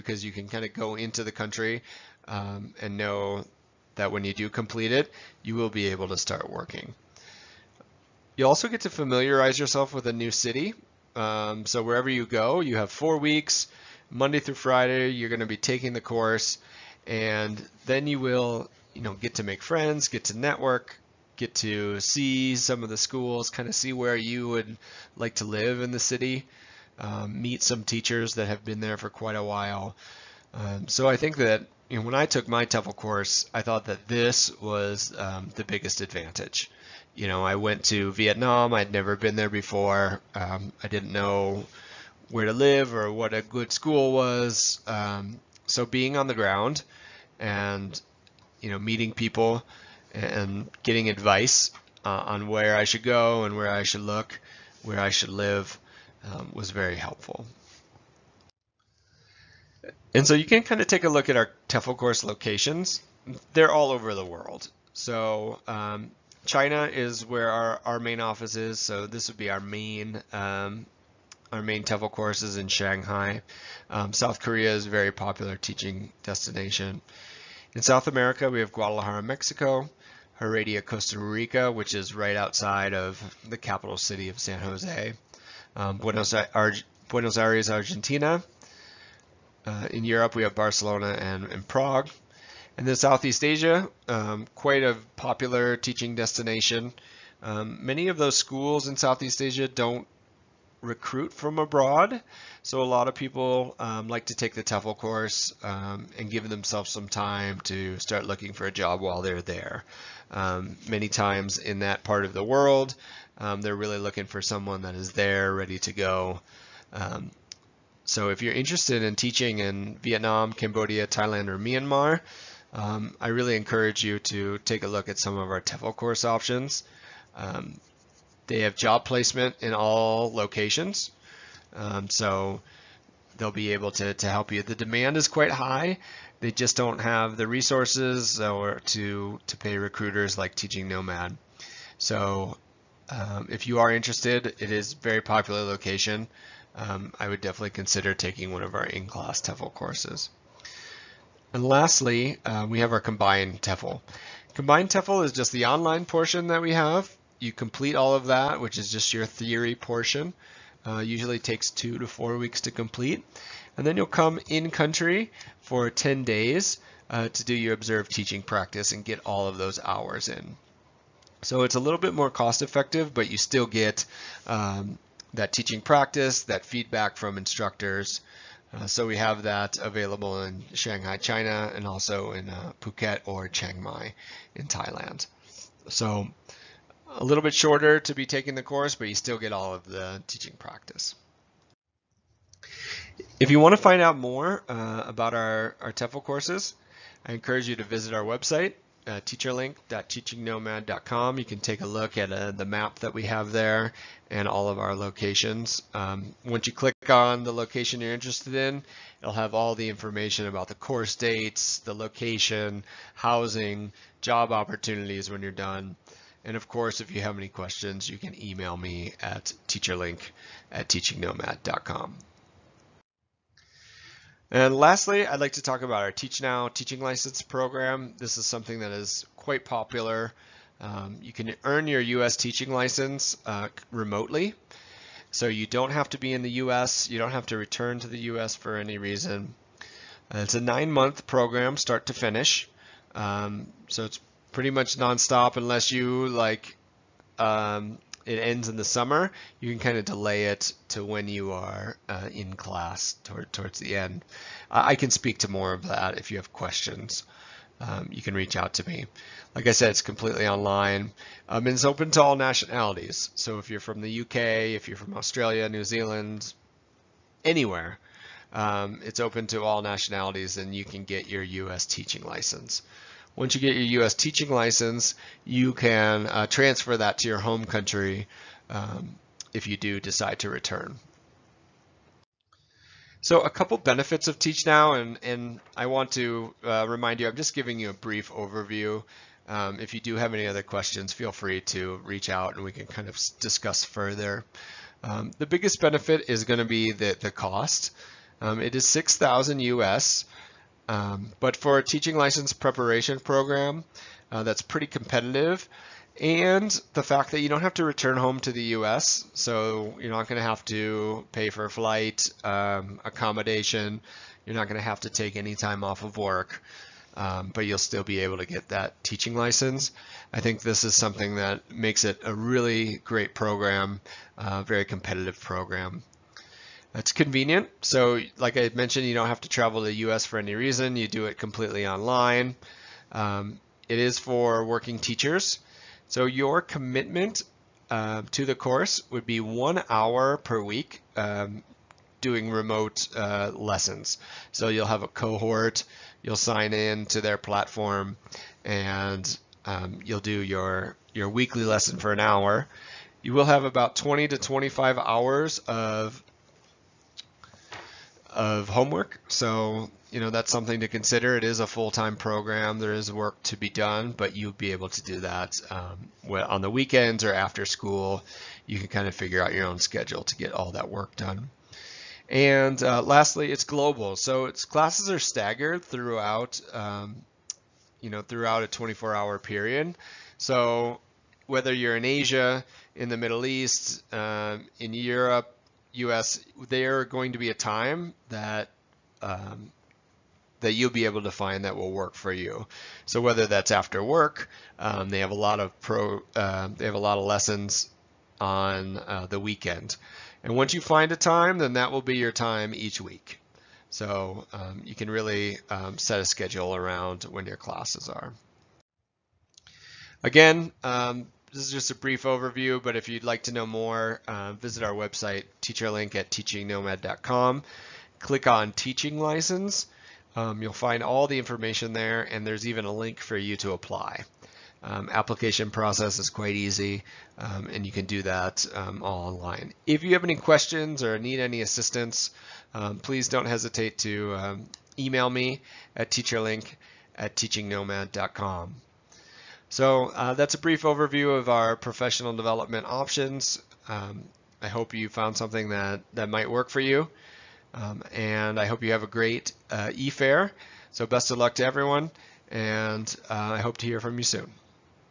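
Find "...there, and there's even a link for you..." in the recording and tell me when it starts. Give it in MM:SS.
07:01.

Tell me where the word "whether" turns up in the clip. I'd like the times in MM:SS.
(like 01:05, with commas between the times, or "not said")
06:21, 06:33.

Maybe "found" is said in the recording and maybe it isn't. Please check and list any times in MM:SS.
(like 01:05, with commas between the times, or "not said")
07:25.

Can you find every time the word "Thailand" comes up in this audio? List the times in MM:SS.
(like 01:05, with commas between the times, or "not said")
02:01, 03:04.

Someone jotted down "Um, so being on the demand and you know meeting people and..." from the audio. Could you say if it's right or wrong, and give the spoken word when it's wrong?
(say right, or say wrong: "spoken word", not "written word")
wrong: "ground", not "demand".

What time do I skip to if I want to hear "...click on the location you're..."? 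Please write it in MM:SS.
03:26.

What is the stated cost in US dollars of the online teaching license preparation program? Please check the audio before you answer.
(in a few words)
6,000.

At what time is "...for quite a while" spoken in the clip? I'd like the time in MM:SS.
00:28.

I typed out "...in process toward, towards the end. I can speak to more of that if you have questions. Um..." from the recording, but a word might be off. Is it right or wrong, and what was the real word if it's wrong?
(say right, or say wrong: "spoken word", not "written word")
wrong: "class", not "process".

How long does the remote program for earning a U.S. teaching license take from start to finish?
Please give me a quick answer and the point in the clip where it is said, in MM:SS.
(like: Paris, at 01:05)
9 months, at 04:00.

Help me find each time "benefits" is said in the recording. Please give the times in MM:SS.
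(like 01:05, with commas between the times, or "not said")
04:43, 04:55.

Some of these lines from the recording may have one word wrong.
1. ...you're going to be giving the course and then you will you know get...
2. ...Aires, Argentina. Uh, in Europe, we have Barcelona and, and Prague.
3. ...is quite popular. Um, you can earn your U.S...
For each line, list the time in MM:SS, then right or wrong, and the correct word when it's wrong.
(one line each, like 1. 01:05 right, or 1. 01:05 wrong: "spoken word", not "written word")
1. 00:15 wrong: "taking", not "giving"
2. 01:27 right
3. 03:48 right.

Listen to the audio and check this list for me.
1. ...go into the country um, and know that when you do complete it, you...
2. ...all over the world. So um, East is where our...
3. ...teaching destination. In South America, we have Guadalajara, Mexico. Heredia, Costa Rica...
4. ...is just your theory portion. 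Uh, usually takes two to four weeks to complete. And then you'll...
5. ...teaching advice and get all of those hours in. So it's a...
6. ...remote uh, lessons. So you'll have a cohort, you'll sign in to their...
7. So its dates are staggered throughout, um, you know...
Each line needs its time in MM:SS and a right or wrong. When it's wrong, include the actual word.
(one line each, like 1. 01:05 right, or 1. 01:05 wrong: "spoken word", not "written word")
1. 00:00 right
2. 01:03 wrong: "China", not "East"
3. 01:15 right
4. 02:38 right
5. 02:48 wrong: "practice", not "advice"
6. 05:42 right
7. 06:14 wrong: "classes", not "dates".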